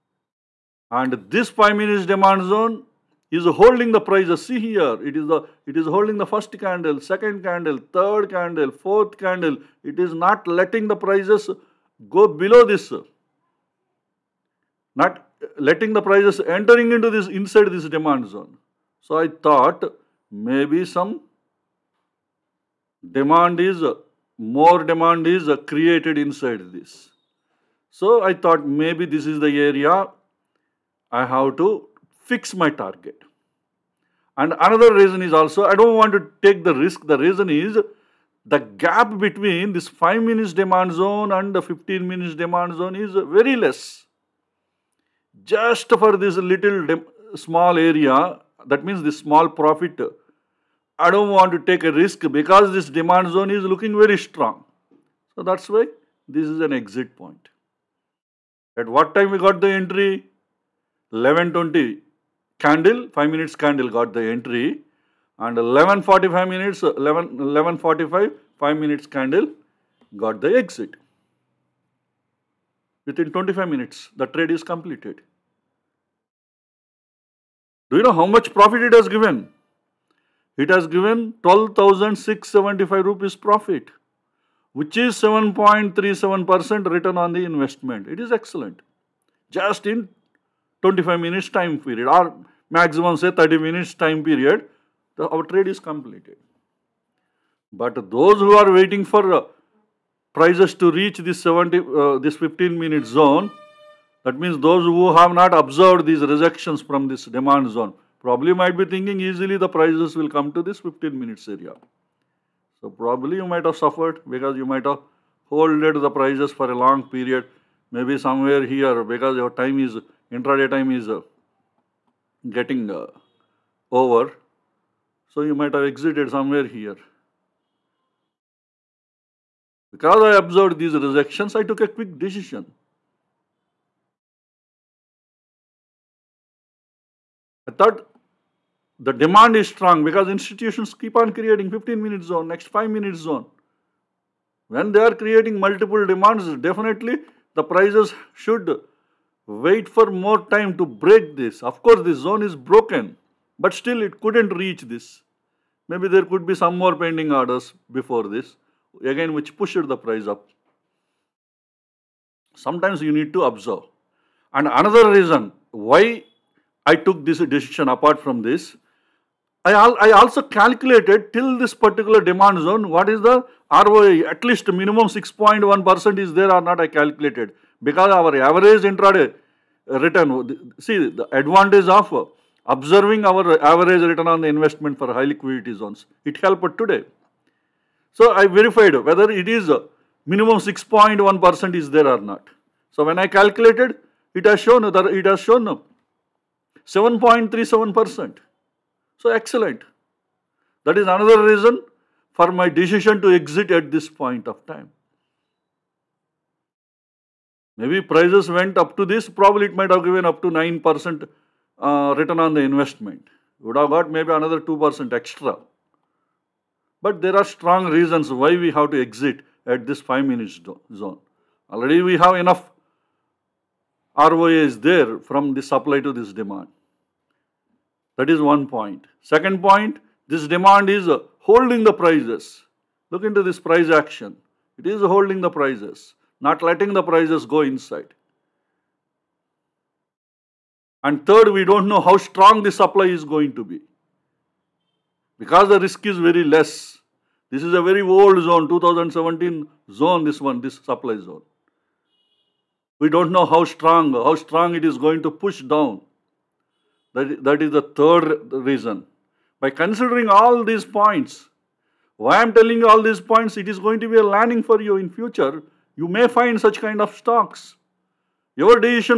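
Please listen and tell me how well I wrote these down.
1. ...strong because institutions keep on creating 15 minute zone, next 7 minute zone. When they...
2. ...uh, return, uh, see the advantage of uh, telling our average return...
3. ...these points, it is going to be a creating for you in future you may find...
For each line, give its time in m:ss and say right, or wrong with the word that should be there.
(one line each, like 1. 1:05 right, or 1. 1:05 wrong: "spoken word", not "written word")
1. 2:19 wrong: "5", not "7"
2. 2:59 wrong: "observing", not "telling"
3. 4:23 wrong: "learning", not "creating".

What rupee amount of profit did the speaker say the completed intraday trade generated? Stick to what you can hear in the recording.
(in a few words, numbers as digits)
12,675 rupees.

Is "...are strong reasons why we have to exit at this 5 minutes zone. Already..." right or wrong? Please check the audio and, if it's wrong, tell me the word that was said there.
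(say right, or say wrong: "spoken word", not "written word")
right.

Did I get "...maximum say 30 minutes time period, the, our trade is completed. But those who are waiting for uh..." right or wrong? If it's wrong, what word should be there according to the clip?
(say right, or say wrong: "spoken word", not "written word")
right.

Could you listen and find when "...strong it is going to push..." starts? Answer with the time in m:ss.
4:14.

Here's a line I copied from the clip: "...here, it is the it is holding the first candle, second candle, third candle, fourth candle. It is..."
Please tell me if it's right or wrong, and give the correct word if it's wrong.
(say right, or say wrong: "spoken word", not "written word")
right.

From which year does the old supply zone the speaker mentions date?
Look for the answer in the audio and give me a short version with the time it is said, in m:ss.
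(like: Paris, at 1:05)
2017, at 4:08.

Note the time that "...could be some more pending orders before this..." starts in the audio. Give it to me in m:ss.
2:36.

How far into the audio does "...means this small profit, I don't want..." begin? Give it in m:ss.
0:48.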